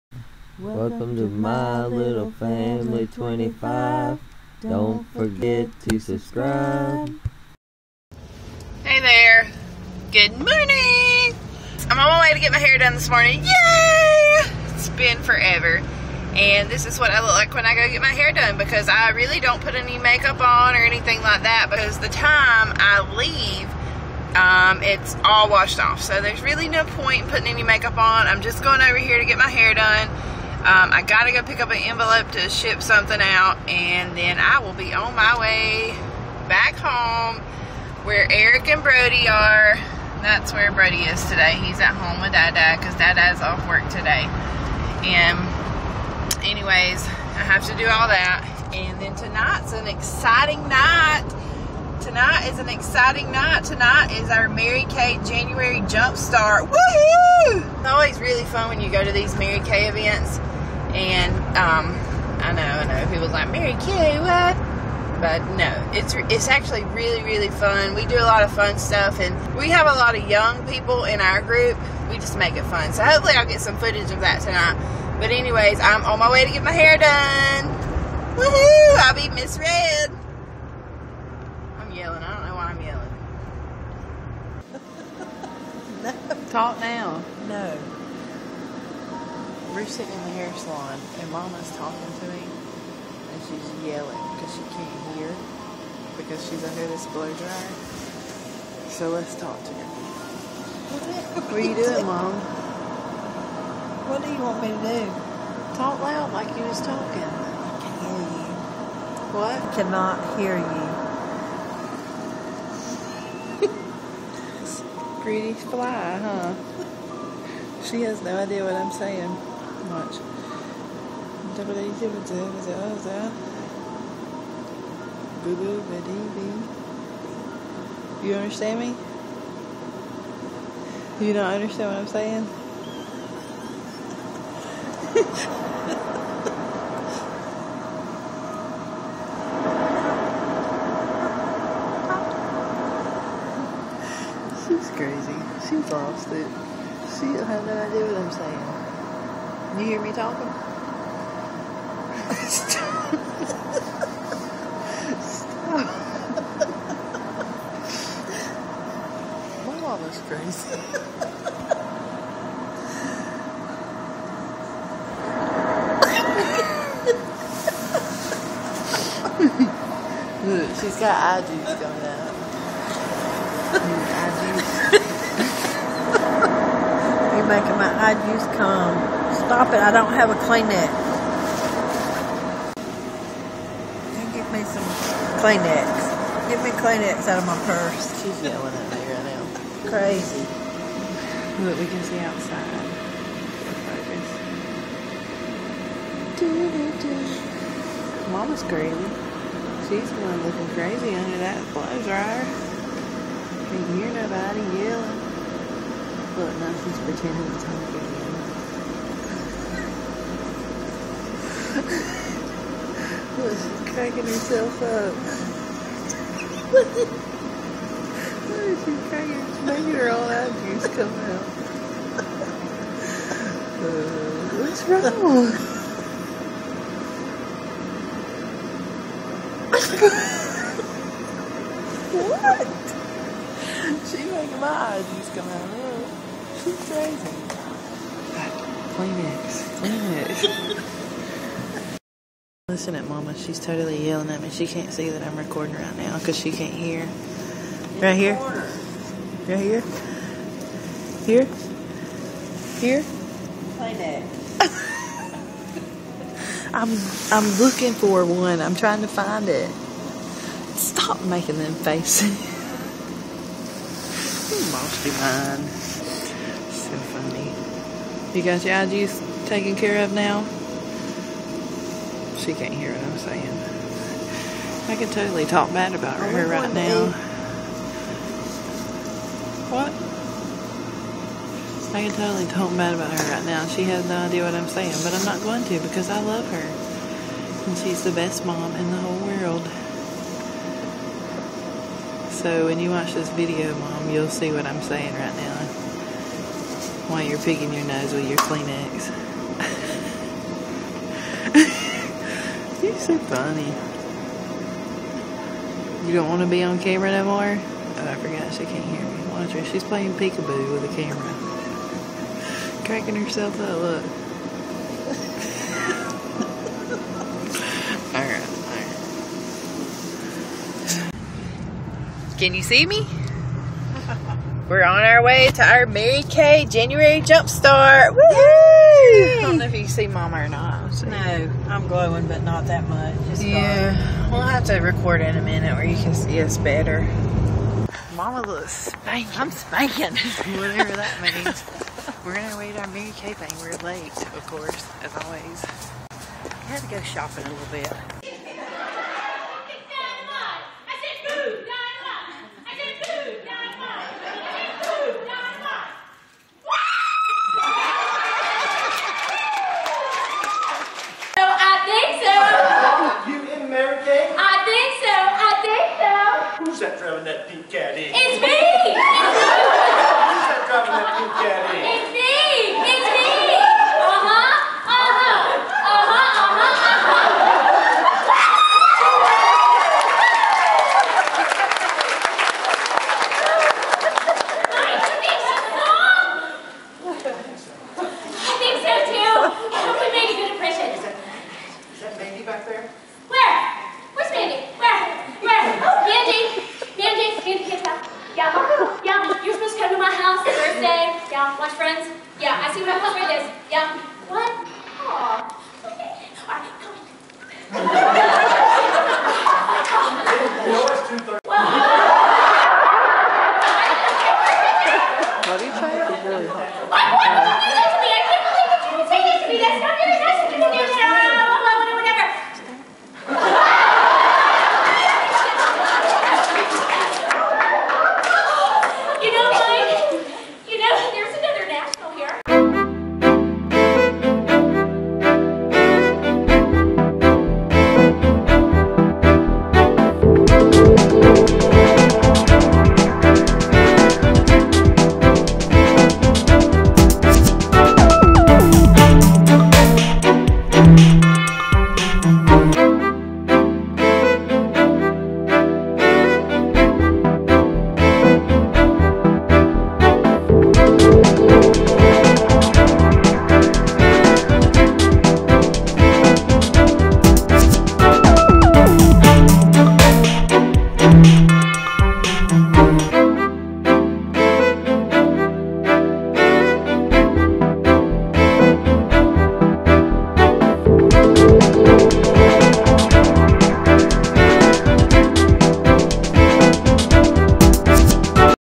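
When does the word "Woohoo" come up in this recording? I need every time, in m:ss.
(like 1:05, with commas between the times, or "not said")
0:56, 1:18, 5:28.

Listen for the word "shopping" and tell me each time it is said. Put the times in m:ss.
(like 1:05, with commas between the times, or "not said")
5:47.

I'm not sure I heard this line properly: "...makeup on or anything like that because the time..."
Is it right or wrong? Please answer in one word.
right.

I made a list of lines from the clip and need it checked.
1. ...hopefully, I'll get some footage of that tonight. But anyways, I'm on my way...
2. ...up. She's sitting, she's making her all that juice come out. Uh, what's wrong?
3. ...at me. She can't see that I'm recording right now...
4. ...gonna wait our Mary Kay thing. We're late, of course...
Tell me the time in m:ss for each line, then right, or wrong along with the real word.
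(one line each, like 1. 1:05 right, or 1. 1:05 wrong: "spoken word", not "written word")
1. 1:13 right
2. 3:34 wrong: "cracking", not "sitting"
3. 4:04 right
4. 5:42 right.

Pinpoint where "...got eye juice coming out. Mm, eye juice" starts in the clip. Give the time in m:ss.
2:50.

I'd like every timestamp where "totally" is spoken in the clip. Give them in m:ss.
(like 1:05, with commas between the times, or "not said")
4:03, 4:35, 4:42.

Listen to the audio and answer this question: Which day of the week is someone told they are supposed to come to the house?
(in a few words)
Thursday.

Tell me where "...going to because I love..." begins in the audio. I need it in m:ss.
4:45.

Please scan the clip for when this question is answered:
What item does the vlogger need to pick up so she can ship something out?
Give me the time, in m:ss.
0:31.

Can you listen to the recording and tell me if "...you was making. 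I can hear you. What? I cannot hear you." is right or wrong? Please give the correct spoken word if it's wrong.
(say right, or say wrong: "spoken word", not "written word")
wrong: "talking", not "making".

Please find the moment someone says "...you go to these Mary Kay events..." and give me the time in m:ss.
0:58.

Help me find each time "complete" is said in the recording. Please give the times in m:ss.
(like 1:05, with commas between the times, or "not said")
not said.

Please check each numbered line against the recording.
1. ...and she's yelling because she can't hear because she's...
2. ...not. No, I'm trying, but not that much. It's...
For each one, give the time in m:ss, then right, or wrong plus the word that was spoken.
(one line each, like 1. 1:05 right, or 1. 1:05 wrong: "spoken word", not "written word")
1. 1:32 right
2. 5:30 wrong: "glowing", not "trying".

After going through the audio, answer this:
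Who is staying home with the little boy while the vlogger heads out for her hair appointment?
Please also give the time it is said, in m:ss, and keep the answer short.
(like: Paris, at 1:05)
Eric, at 0:38.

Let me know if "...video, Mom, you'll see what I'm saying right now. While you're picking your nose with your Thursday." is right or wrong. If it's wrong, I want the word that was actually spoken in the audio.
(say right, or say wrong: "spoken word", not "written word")
wrong: "Kleenex", not "Thursday".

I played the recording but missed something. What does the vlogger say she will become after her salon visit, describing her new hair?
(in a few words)
Miss Red.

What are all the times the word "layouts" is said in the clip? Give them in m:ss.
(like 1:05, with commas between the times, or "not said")
not said.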